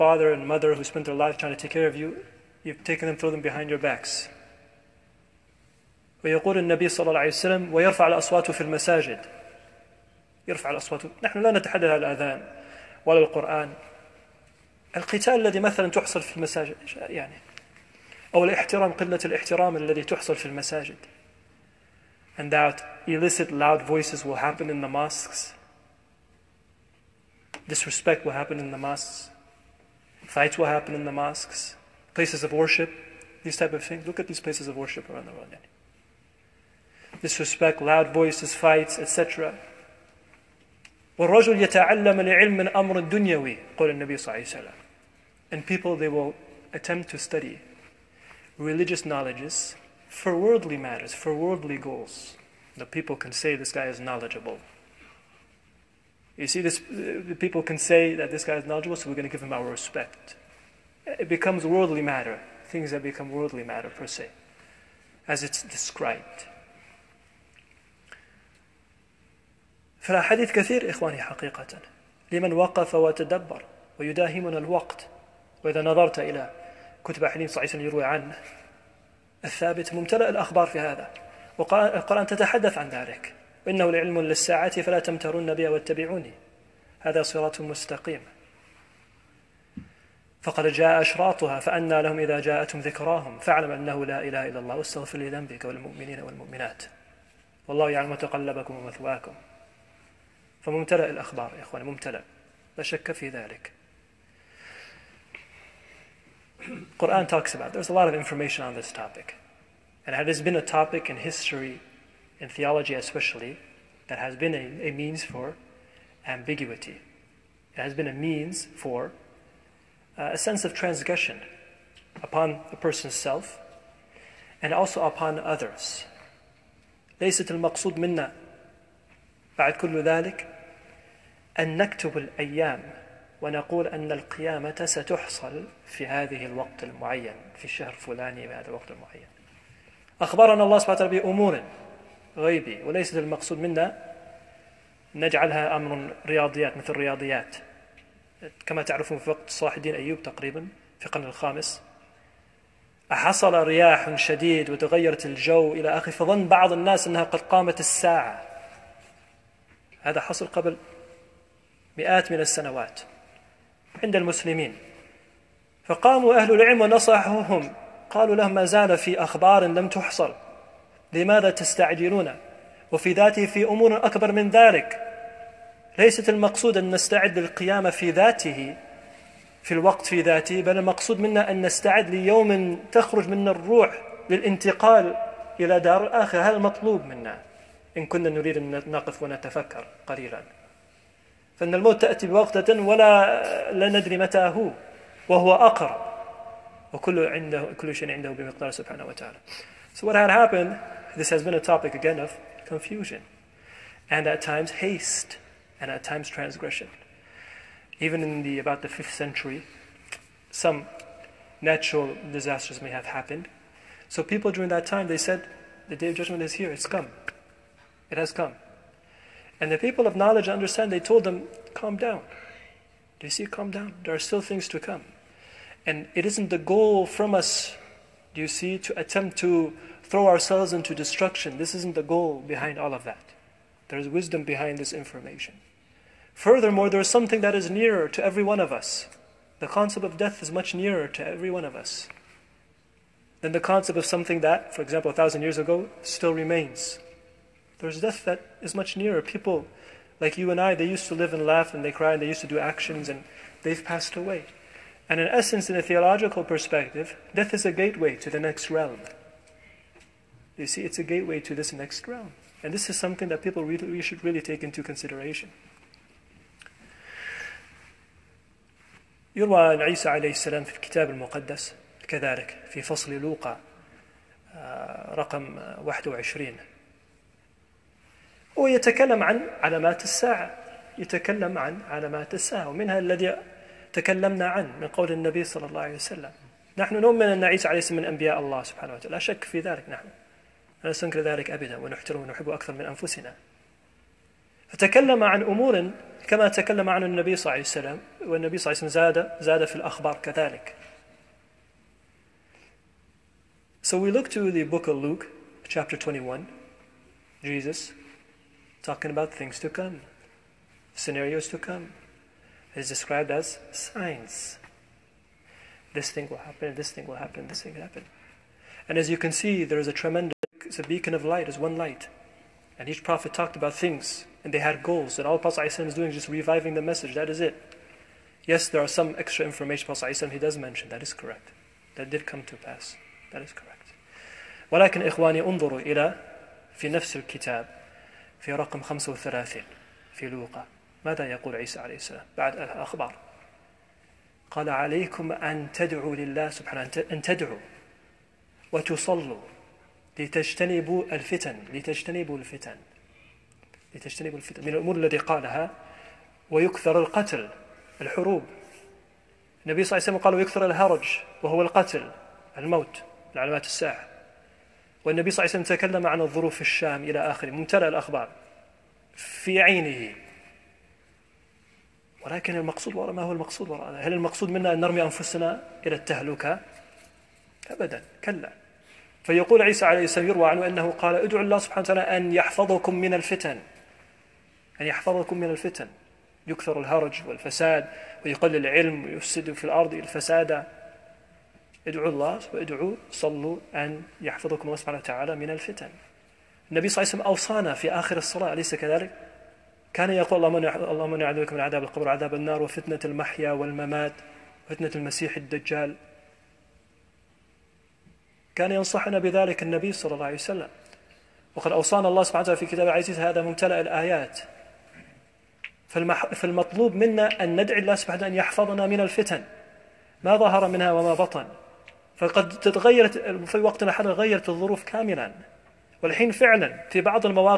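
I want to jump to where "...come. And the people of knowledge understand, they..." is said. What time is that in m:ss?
3:38.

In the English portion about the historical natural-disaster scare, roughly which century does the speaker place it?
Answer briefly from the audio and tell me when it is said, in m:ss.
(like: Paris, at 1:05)
5th century, at 3:28.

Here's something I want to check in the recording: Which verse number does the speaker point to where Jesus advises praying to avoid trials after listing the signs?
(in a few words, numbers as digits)
35.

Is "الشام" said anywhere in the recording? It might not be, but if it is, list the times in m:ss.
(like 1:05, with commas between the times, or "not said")
6:06.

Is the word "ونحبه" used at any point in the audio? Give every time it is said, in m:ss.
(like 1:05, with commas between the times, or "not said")
4:52.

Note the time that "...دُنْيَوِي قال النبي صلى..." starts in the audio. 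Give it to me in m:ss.
0:43.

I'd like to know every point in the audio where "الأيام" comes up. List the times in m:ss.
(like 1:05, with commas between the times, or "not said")
2:12.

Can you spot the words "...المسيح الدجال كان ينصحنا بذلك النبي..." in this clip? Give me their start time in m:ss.
6:44.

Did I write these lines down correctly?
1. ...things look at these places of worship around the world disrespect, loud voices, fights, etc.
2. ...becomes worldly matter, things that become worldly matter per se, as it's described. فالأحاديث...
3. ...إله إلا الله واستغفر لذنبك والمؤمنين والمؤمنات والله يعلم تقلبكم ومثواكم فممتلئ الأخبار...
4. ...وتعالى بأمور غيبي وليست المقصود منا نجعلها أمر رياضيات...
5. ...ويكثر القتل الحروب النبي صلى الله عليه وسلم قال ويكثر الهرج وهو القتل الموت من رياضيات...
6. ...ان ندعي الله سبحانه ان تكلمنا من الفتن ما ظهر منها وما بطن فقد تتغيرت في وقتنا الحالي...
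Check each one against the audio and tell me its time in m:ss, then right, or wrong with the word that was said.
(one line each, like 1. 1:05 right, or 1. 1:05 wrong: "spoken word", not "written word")
1. 0:33 right
2. 1:01 right
3. 1:34 right
4. 2:20 right
5. 5:56 wrong: "علامات", not "رياضيات"
6. 6:57 wrong: "يحفظنا", not "تكلمنا".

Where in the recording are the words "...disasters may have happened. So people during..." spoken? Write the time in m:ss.
3:32.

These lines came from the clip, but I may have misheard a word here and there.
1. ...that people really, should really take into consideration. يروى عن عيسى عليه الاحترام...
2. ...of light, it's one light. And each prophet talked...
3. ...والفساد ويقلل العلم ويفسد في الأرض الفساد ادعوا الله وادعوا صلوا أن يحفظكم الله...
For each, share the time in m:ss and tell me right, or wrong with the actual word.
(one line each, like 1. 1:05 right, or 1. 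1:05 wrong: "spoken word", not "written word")
1. 4:23 wrong: "السلام", not "الاحترام"
2. 5:21 right
3. 6:27 right.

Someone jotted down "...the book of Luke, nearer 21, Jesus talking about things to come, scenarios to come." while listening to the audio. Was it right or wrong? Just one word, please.
wrong.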